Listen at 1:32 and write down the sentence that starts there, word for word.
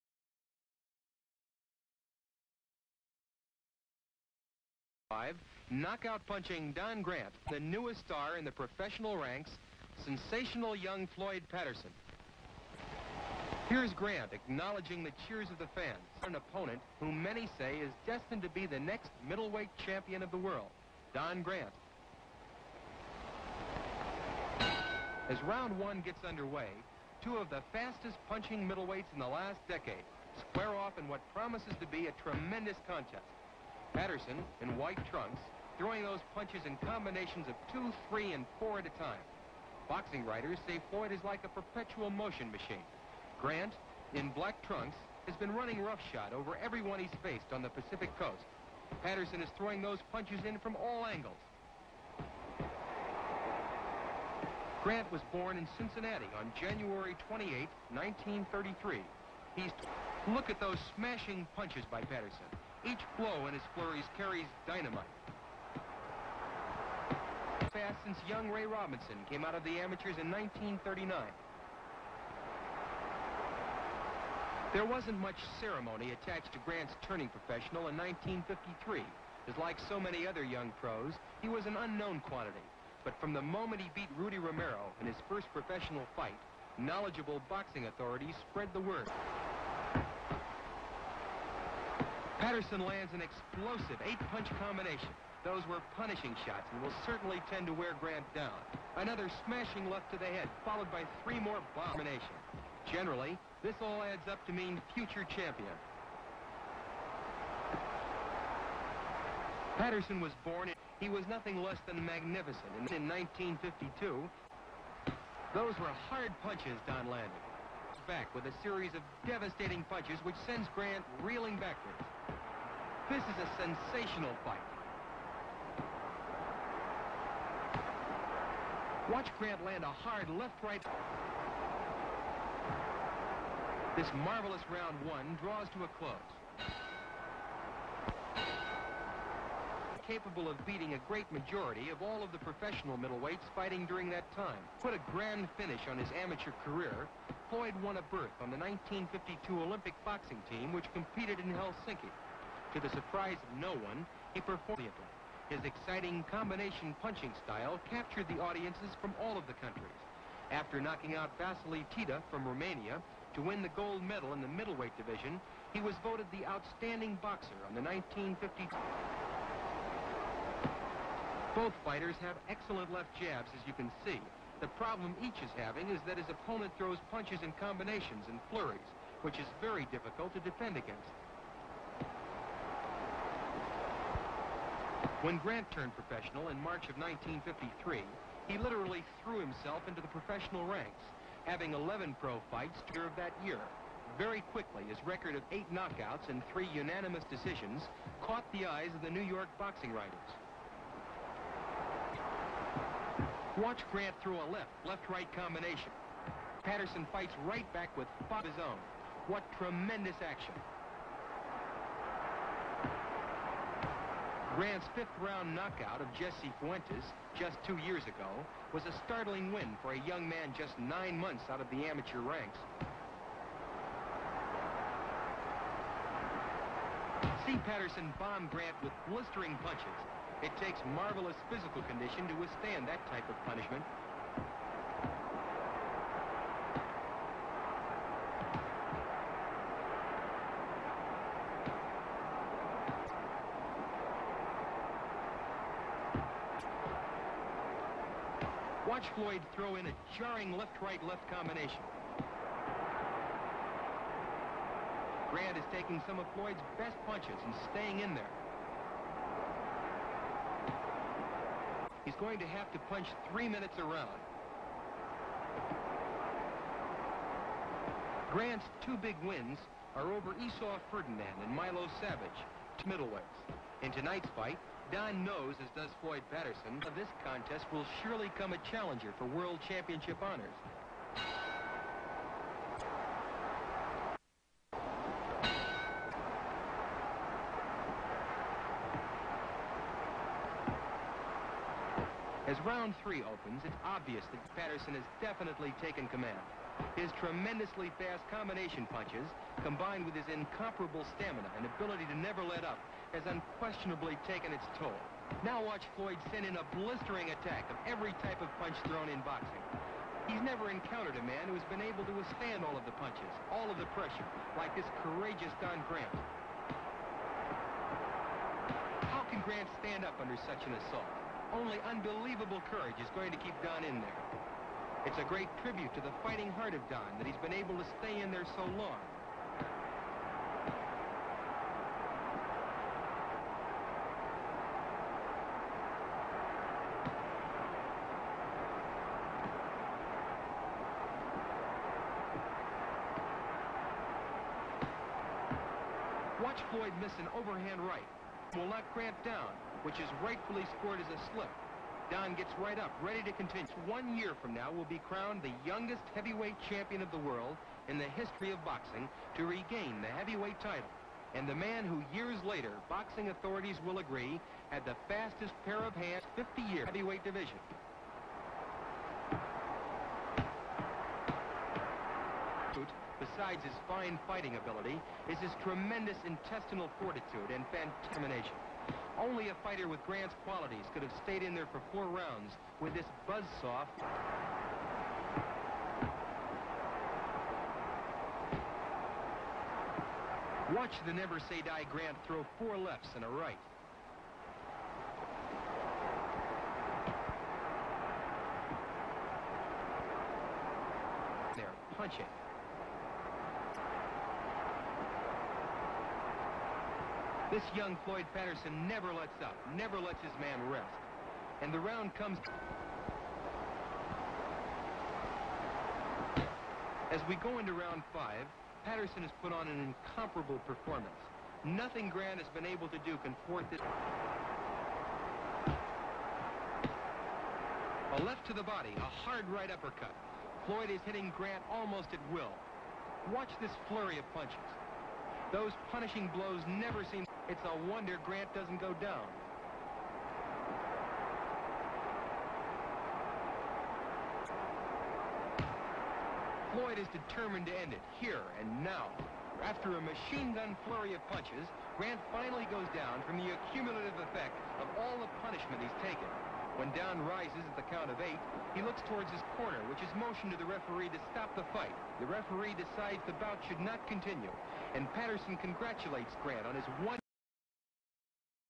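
Patterson lands an explosive eight-punch combination.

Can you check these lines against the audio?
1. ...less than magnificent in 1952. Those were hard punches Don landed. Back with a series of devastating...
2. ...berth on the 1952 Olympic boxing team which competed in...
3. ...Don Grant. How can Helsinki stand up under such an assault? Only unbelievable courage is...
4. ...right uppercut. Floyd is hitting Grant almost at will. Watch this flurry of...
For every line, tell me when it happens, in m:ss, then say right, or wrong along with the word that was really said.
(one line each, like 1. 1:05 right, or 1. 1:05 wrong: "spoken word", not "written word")
1. 1:51 right
2. 2:28 right
3. 5:15 wrong: "Grant", not "Helsinki"
4. 7:09 right.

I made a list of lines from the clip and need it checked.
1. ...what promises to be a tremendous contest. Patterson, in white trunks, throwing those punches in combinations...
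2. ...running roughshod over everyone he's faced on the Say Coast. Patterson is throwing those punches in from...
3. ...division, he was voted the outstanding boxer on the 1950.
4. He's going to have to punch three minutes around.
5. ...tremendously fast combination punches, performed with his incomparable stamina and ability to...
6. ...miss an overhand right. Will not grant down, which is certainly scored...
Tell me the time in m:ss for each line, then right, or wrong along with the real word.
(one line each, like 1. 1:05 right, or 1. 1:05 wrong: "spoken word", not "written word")
1. 0:31 right
2. 0:45 wrong: "Pacific", not "Say"
3. 2:44 right
4. 4:22 right
5. 4:57 wrong: "combined", not "performed"
6. 5:47 wrong: "rightfully", not "certainly".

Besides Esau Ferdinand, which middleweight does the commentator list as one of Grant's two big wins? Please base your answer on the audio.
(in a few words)
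Milo Savage.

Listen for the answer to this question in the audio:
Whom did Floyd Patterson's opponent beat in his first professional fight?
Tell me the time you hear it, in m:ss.
1:24.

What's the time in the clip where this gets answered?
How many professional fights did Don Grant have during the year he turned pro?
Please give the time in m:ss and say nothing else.
3:11.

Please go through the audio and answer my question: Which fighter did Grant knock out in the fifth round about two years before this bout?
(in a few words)
Jesse Fuentes.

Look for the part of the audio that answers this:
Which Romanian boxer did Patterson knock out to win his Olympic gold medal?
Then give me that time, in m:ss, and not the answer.
2:41.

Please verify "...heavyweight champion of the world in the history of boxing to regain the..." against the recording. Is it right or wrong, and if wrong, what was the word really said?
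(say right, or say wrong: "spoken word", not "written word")
right.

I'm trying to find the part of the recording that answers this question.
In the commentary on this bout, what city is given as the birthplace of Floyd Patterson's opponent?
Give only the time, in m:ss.
0:55.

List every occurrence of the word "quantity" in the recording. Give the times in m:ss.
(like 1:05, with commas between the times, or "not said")
1:22.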